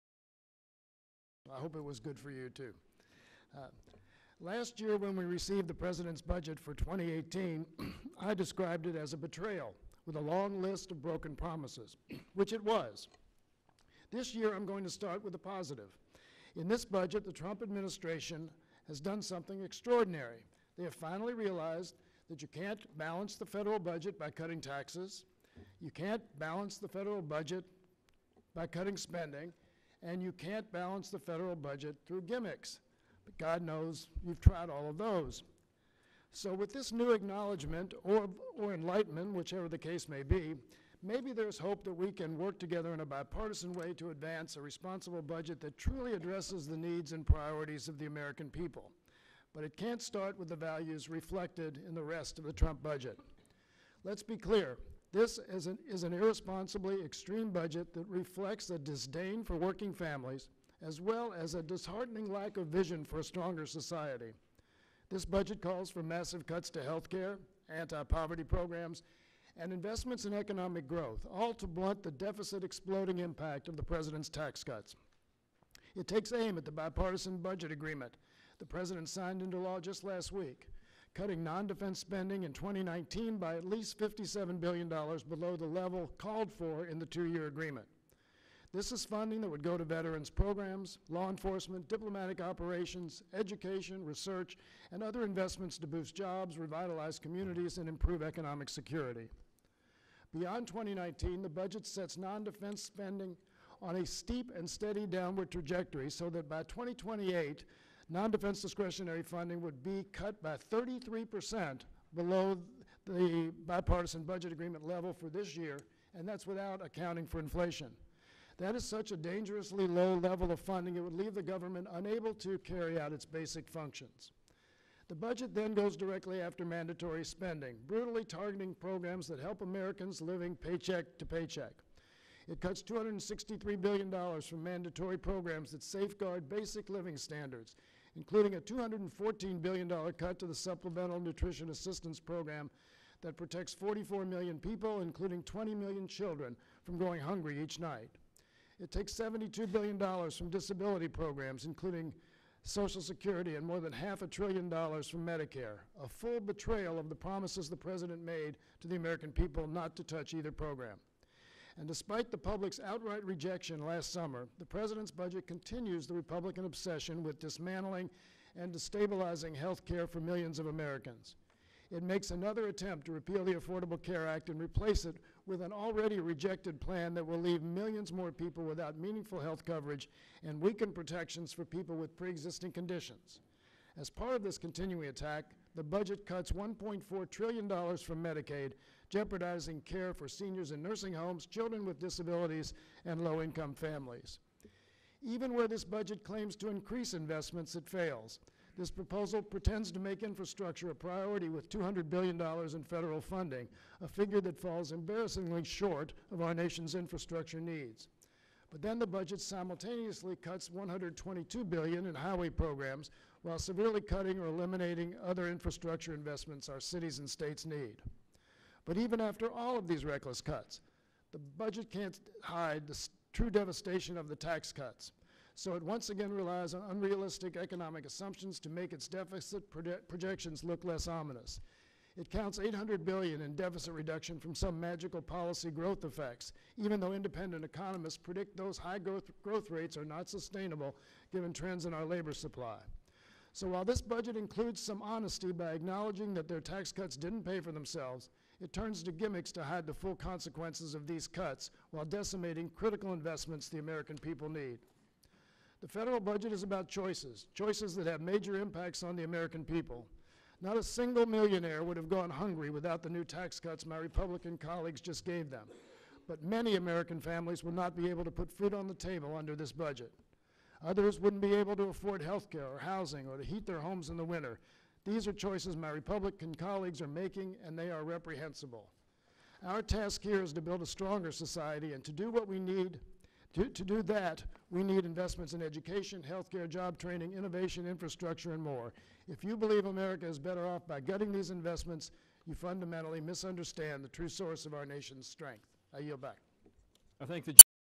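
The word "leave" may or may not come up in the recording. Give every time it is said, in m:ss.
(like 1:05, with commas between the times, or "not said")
2:01, 2:57.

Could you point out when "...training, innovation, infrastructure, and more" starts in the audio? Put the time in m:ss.
4:46.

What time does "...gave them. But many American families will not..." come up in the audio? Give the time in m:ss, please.
4:25.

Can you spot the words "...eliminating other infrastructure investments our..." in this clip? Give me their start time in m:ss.
3:34.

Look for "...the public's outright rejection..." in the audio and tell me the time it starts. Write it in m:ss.
2:42.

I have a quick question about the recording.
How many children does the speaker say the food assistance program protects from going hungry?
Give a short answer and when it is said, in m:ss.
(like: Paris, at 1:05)
20 million, at 2:25.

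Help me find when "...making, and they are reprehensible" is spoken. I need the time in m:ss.
4:37.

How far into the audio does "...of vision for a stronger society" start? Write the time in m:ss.
1:02.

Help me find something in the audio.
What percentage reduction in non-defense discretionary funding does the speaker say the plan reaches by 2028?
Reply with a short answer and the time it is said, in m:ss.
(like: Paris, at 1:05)
33%, at 1:50.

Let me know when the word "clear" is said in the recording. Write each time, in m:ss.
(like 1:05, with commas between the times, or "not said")
0:54.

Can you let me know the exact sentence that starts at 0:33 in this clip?
But God knows you've tried all of those.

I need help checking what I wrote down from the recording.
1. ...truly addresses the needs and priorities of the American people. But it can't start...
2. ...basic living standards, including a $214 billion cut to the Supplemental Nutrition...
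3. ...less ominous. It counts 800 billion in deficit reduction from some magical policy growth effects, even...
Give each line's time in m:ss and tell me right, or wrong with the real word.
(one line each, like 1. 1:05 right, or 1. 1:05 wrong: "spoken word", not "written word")
1. 0:45 right
2. 2:16 right
3. 3:50 right.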